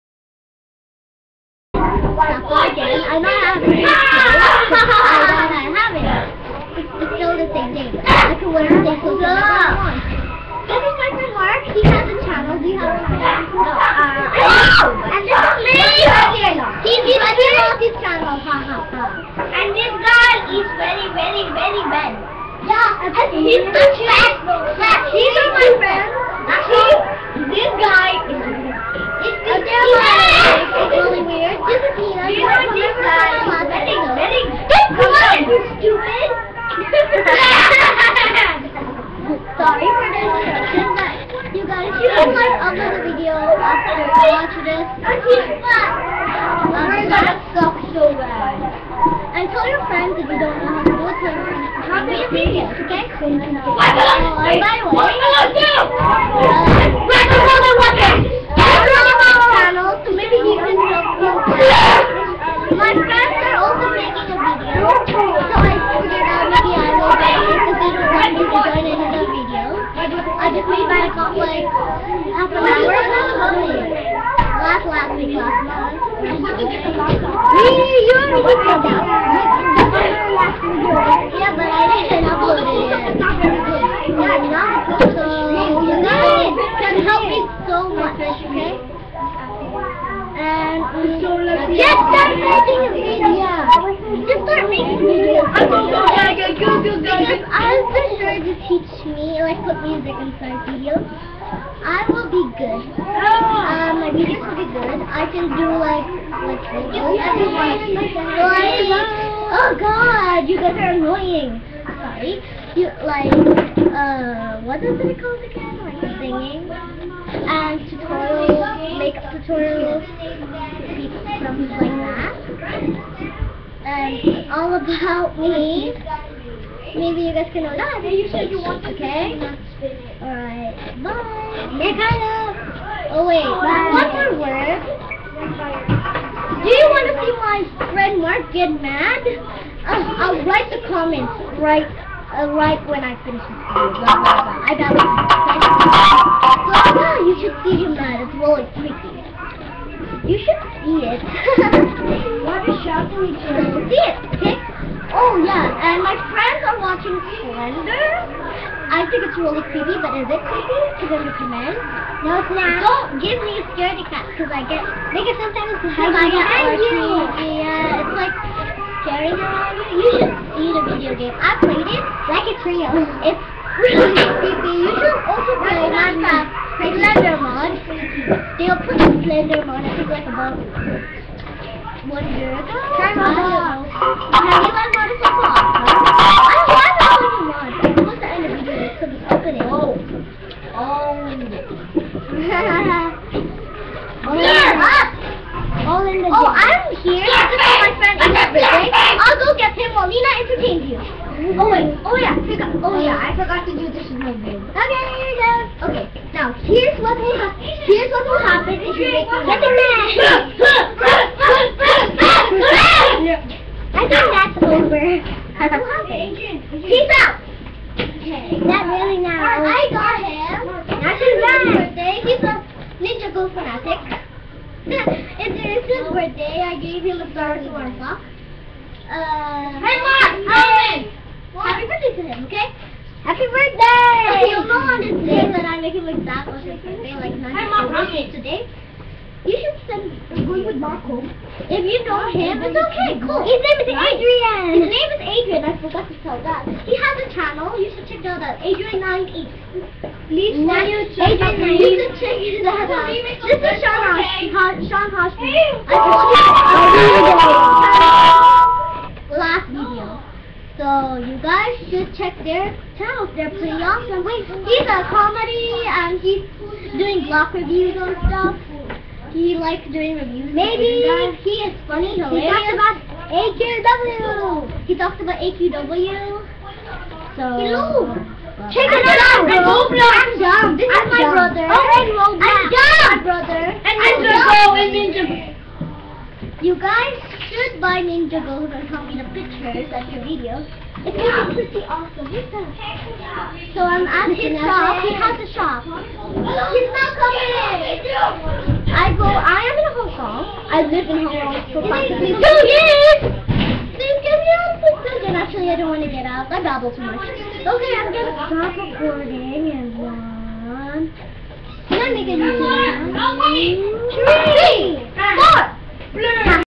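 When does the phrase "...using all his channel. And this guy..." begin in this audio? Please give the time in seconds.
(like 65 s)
17 s.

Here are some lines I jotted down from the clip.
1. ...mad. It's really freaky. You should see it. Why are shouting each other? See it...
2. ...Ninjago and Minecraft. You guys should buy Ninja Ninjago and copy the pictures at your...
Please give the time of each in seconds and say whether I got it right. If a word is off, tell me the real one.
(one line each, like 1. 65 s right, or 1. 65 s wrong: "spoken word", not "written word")
1. 147 s right
2. 284 s wrong: "Ninjago", not "Minecraft".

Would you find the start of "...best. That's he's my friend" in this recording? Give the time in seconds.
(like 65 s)
23 s.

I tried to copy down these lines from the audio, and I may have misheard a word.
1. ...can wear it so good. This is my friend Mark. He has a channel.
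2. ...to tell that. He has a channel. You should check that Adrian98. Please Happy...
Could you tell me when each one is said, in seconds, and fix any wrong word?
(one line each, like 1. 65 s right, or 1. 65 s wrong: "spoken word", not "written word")
1. 8 s right
2. 246 s wrong: "Adrian", not "Happy".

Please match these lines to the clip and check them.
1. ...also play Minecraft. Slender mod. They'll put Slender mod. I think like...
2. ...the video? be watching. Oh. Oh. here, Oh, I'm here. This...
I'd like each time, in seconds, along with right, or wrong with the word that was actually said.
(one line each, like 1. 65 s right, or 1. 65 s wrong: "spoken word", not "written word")
1. 175 s right
2. 188 s wrong: "opening", not "watching".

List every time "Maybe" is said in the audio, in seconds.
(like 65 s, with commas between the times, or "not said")
126 s, 270 s.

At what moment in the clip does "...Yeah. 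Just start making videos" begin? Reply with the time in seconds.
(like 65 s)
93 s.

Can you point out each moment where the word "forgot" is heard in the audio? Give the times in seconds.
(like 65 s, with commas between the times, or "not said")
203 s, 245 s.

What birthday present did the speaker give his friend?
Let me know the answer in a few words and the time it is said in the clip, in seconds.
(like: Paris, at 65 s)
Star Wars box, at 227 s.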